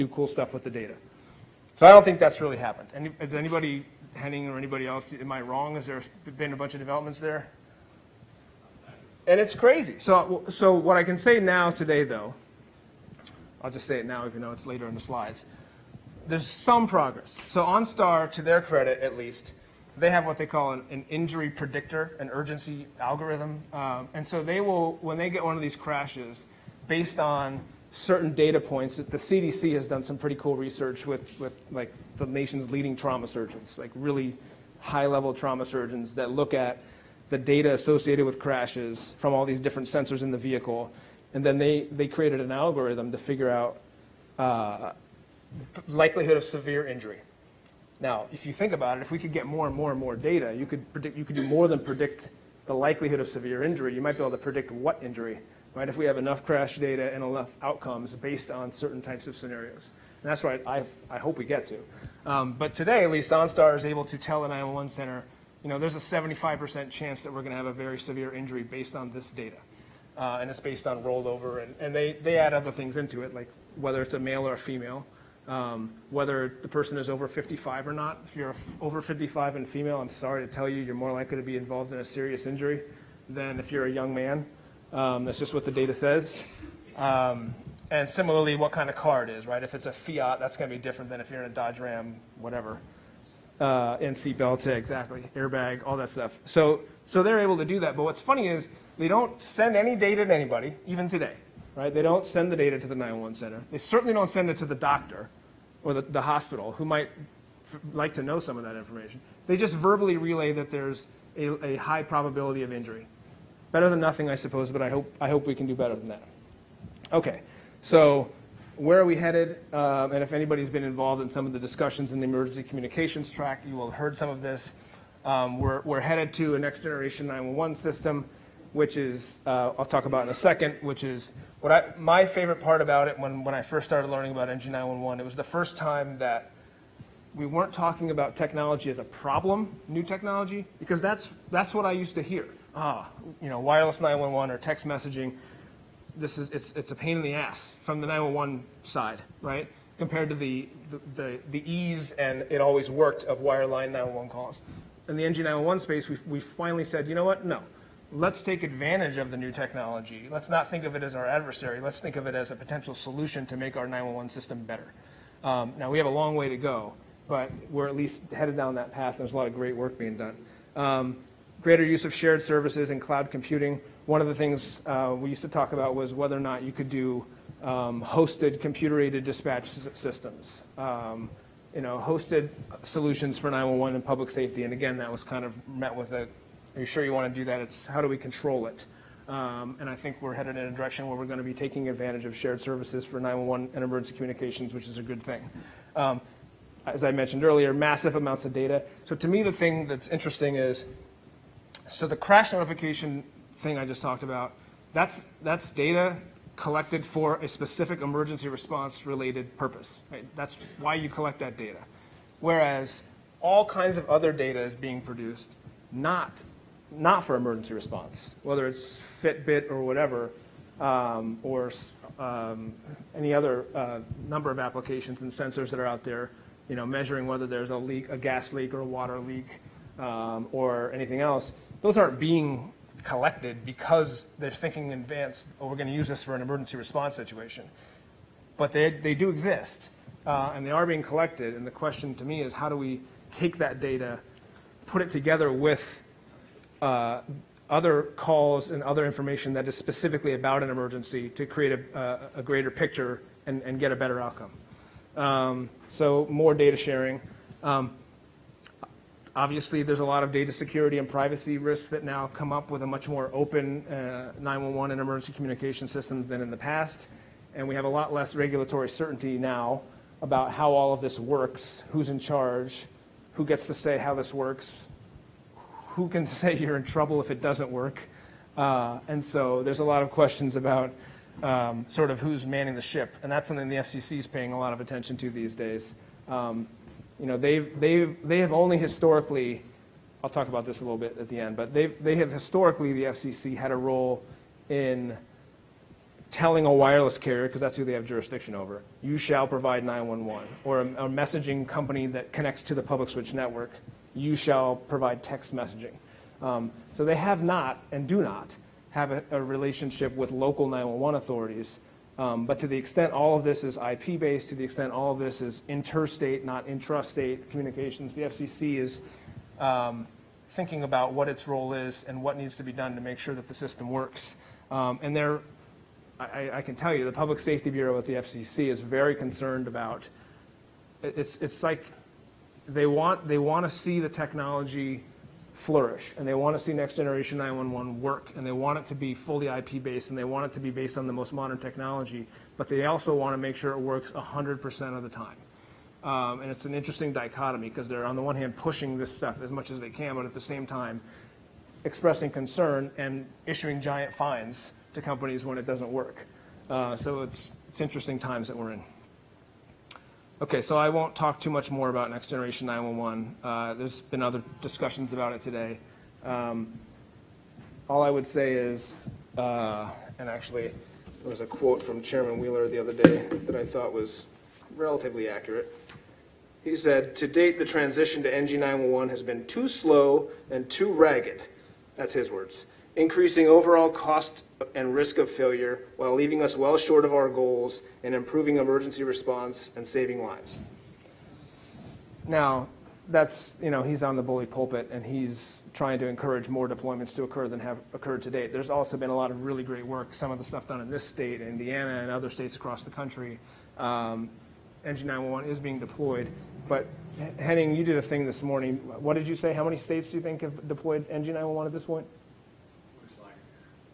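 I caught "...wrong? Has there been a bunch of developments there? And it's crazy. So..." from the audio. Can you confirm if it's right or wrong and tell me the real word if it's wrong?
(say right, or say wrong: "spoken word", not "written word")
right.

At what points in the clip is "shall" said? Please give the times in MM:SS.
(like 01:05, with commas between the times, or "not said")
04:59, 05:04.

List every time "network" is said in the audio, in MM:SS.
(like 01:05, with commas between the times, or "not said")
05:03.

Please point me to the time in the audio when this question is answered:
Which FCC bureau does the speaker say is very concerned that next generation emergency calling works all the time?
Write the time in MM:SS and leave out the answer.
05:27.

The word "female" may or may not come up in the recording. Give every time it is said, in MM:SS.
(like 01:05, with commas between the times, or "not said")
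01:14, 01:19.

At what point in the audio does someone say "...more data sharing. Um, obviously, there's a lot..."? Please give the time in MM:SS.
04:16.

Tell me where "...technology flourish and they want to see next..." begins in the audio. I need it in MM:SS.
05:34.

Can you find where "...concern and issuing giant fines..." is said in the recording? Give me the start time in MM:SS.
05:52.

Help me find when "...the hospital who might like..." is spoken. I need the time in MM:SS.
01:46.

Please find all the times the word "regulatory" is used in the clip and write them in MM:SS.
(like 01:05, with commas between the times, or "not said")
04:28.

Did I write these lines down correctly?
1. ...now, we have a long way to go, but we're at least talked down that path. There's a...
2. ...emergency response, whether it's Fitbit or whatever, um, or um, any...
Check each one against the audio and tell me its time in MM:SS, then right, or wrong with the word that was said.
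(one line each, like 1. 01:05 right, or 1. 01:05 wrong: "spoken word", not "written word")
1. 02:45 wrong: "headed", not "talked"
2. 03:37 right.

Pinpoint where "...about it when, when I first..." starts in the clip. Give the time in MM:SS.
02:12.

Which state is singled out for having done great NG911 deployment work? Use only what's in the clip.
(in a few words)
Indiana.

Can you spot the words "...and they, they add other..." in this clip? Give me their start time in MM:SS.
01:11.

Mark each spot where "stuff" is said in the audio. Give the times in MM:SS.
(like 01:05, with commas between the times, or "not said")
00:00, 01:36, 05:49, 06:40.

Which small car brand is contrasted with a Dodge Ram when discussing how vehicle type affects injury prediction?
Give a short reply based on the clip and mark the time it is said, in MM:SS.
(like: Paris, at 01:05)
Fiat, at 01:29.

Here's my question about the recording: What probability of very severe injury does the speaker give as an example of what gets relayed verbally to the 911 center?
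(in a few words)
75%.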